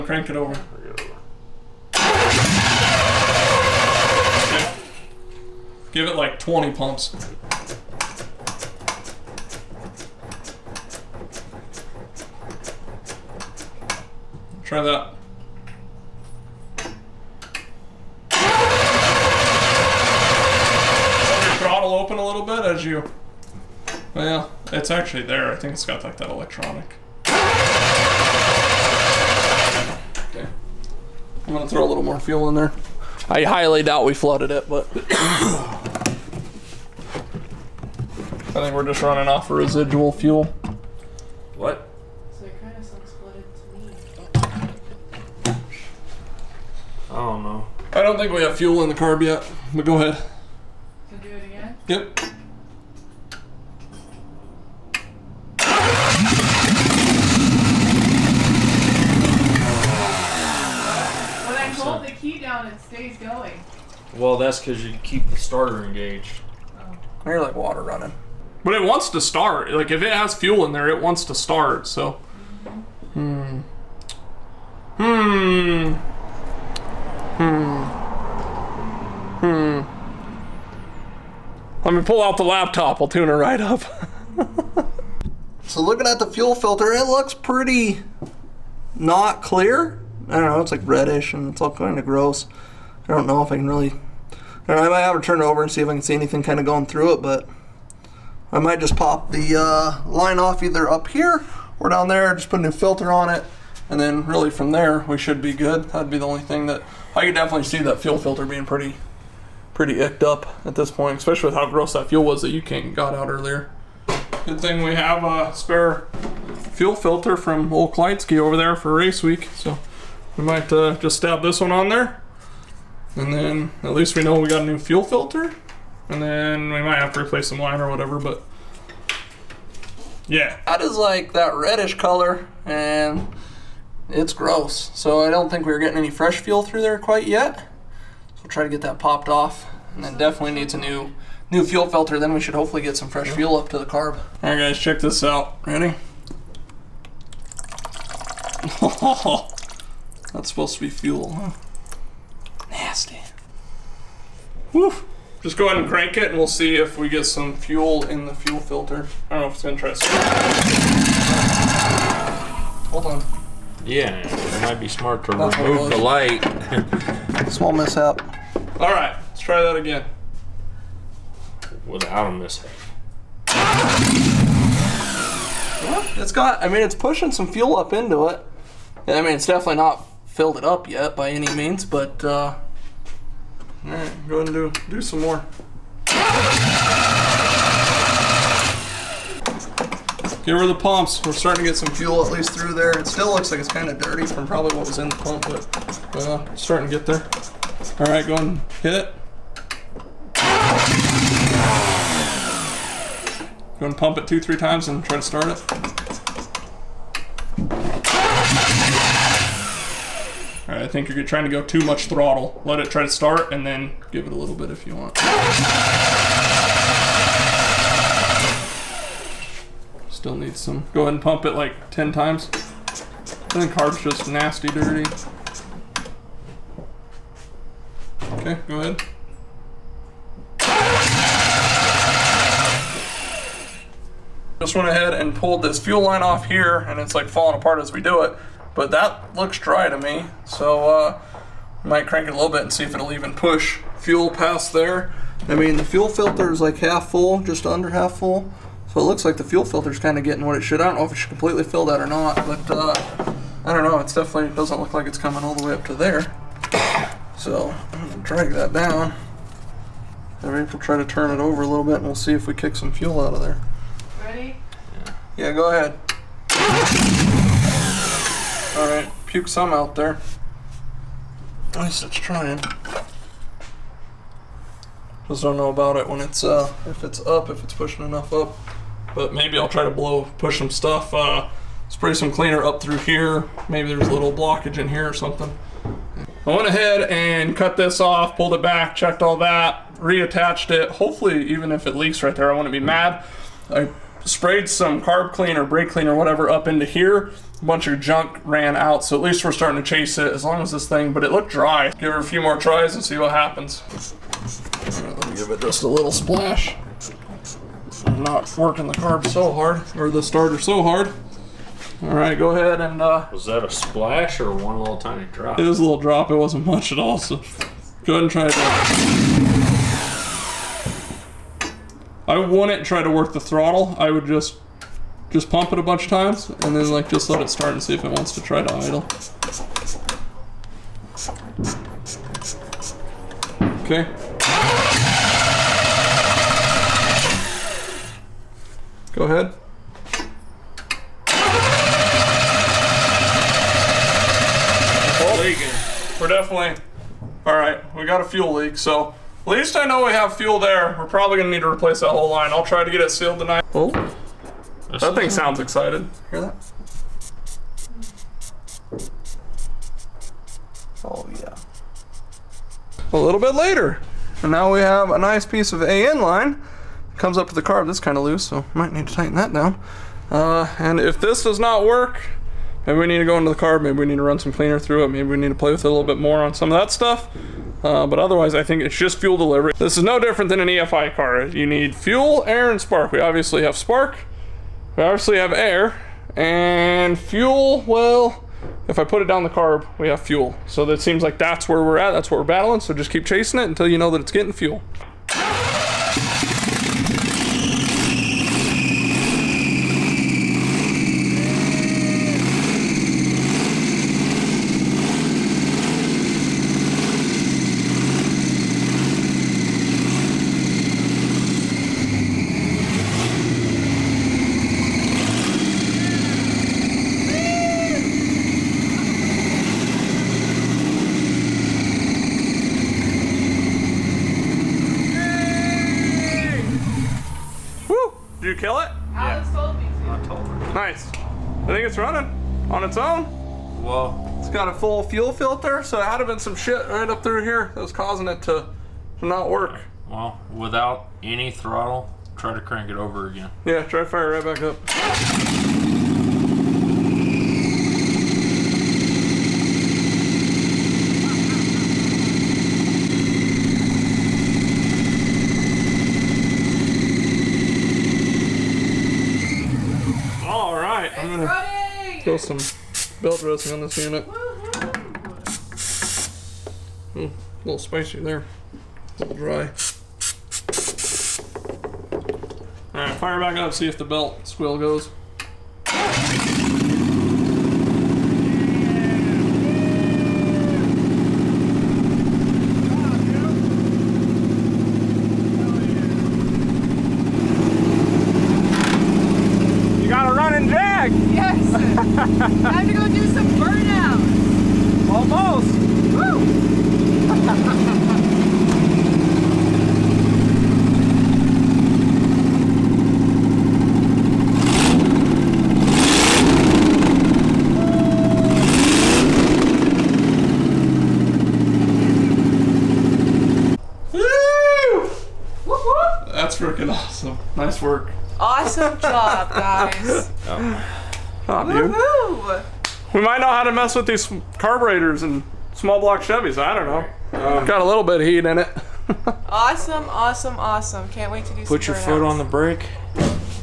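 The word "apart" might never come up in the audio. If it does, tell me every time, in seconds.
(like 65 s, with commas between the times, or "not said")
237 s.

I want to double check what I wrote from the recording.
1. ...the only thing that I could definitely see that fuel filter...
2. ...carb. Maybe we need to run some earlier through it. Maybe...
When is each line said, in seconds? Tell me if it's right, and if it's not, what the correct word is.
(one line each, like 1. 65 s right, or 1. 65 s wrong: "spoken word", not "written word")
1. 106 s right
2. 373 s wrong: "cleaner", not "earlier".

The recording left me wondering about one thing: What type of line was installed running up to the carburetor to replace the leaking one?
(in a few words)
AN line.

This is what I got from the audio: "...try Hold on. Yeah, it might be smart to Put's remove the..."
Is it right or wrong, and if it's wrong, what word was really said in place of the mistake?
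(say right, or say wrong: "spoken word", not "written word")
wrong: "That", not "Put".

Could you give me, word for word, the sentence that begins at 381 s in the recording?
You need fuel, air, and spark.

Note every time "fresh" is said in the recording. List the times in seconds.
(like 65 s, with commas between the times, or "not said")
136 s, 143 s.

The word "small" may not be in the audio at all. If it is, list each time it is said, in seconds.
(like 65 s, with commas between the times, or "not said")
167 s, 525 s.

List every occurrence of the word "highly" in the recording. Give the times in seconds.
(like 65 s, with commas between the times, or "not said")
33 s.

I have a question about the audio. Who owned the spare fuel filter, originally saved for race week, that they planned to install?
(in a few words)
Old Kleitsky.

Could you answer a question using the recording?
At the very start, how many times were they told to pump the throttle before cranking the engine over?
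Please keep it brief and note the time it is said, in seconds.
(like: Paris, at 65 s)
20, at 6 s.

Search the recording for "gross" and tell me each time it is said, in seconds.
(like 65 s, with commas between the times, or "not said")
92 s, 111 s, 134 s.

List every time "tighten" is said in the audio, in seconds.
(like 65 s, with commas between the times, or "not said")
369 s.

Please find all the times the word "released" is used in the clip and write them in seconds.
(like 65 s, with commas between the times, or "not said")
not said.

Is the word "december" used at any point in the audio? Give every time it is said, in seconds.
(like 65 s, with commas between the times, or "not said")
not said.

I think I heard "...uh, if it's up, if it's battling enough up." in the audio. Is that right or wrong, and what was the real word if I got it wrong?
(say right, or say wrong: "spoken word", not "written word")
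wrong: "pushing", not "battling".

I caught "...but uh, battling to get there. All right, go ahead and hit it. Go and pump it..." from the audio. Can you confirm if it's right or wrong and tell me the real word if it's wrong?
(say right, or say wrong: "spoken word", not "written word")
wrong: "starting", not "battling".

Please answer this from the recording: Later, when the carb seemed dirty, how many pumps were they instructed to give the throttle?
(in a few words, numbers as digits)
10.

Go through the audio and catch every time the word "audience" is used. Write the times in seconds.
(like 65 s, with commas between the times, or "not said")
not said.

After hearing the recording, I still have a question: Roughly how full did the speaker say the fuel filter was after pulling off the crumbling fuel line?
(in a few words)
Just under half.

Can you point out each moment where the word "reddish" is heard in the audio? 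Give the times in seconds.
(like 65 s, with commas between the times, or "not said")
90 s, 131 s.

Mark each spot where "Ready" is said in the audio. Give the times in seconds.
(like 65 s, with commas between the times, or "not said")
145 s, 264 s.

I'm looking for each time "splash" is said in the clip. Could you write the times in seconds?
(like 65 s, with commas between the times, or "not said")
306 s, 313 s.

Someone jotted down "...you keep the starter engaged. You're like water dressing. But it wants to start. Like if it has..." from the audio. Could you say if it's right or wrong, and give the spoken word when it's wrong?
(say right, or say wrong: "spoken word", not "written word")
wrong: "running", not "dressing".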